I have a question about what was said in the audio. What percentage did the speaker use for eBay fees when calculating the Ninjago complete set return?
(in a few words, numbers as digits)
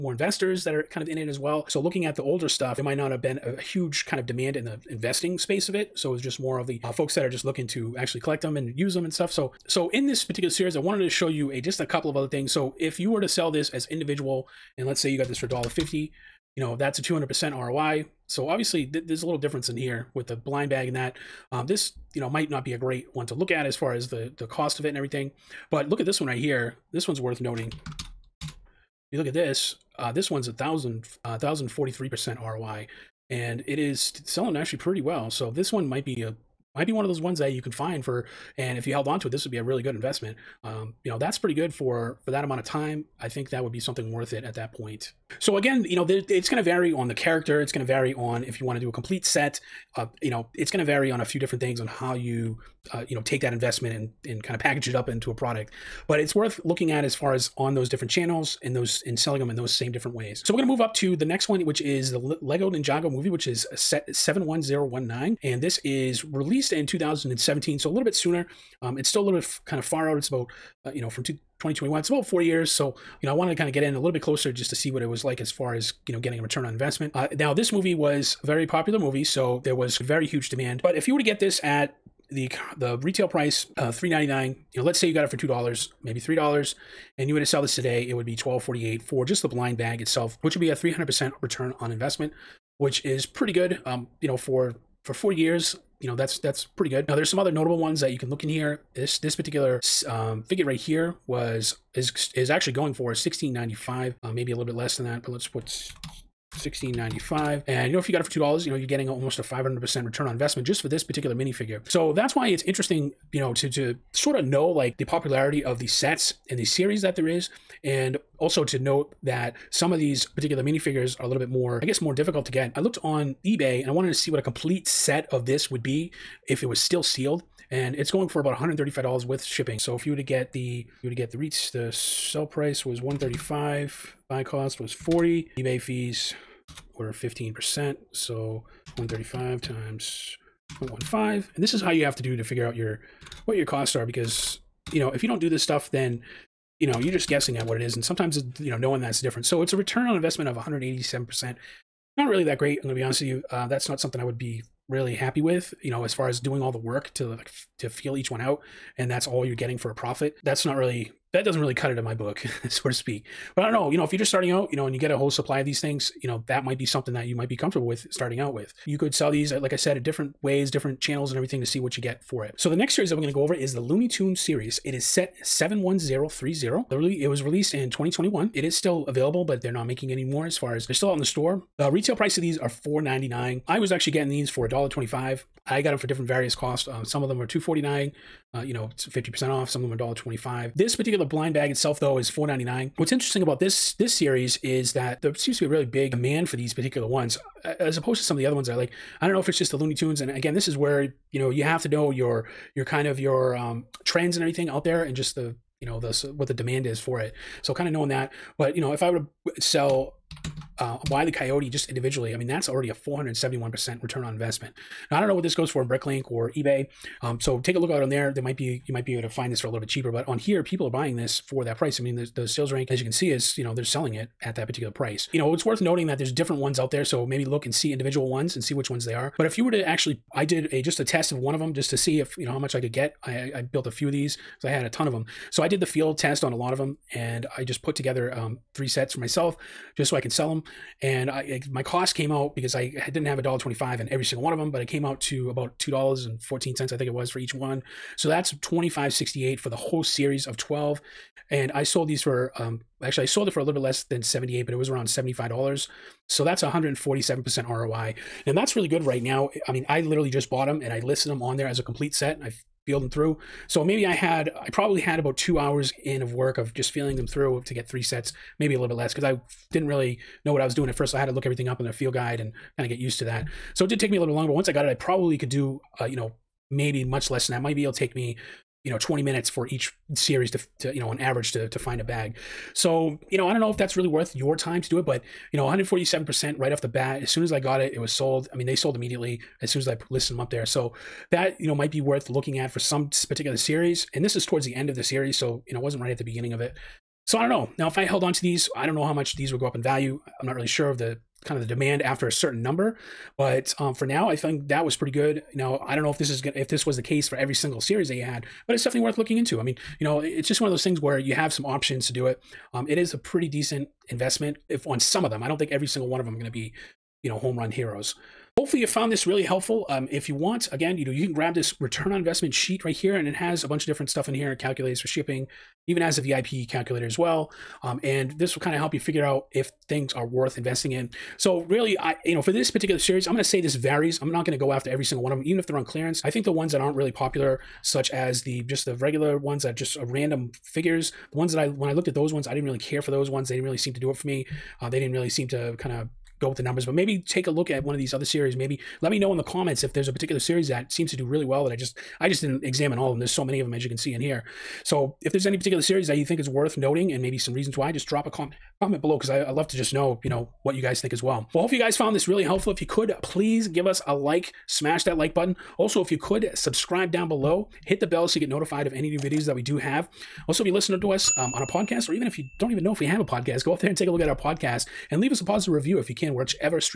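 15%.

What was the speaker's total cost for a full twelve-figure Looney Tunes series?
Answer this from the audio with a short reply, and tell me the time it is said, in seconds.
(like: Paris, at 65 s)
$25.68, at 248 s.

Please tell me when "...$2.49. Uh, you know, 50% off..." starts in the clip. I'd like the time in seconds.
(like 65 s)
187 s.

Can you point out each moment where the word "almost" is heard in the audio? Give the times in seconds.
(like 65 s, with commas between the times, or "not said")
109 s.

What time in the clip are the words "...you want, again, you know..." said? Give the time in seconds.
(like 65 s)
320 s.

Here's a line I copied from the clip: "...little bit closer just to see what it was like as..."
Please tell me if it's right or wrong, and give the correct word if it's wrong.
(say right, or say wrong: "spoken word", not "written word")
right.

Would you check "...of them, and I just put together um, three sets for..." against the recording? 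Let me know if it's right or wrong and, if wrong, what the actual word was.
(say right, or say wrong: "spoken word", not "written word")
right.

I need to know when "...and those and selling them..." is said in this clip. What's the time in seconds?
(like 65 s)
58 s.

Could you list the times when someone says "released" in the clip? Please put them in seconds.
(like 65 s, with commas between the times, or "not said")
66 s, 177 s.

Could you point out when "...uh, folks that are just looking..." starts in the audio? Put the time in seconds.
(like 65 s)
6 s.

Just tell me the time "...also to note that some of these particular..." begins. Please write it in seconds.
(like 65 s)
118 s.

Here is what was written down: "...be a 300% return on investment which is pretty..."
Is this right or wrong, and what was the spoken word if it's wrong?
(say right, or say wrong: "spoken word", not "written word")
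right.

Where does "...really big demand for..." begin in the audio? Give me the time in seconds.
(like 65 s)
195 s.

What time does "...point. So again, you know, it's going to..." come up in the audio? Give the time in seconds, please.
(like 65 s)
44 s.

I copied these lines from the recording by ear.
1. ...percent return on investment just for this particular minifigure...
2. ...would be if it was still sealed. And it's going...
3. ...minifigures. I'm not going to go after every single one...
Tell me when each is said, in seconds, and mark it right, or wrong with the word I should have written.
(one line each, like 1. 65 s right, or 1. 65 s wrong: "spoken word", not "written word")
1. 109 s right
2. 125 s right
3. 333 s wrong: "varies", not "minifigures".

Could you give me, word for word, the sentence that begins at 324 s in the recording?
It calculates for shipping, even has a VIP calculator as well.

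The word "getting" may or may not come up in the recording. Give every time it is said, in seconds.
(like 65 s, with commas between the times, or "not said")
76 s, 108 s, 159 s, 184 s.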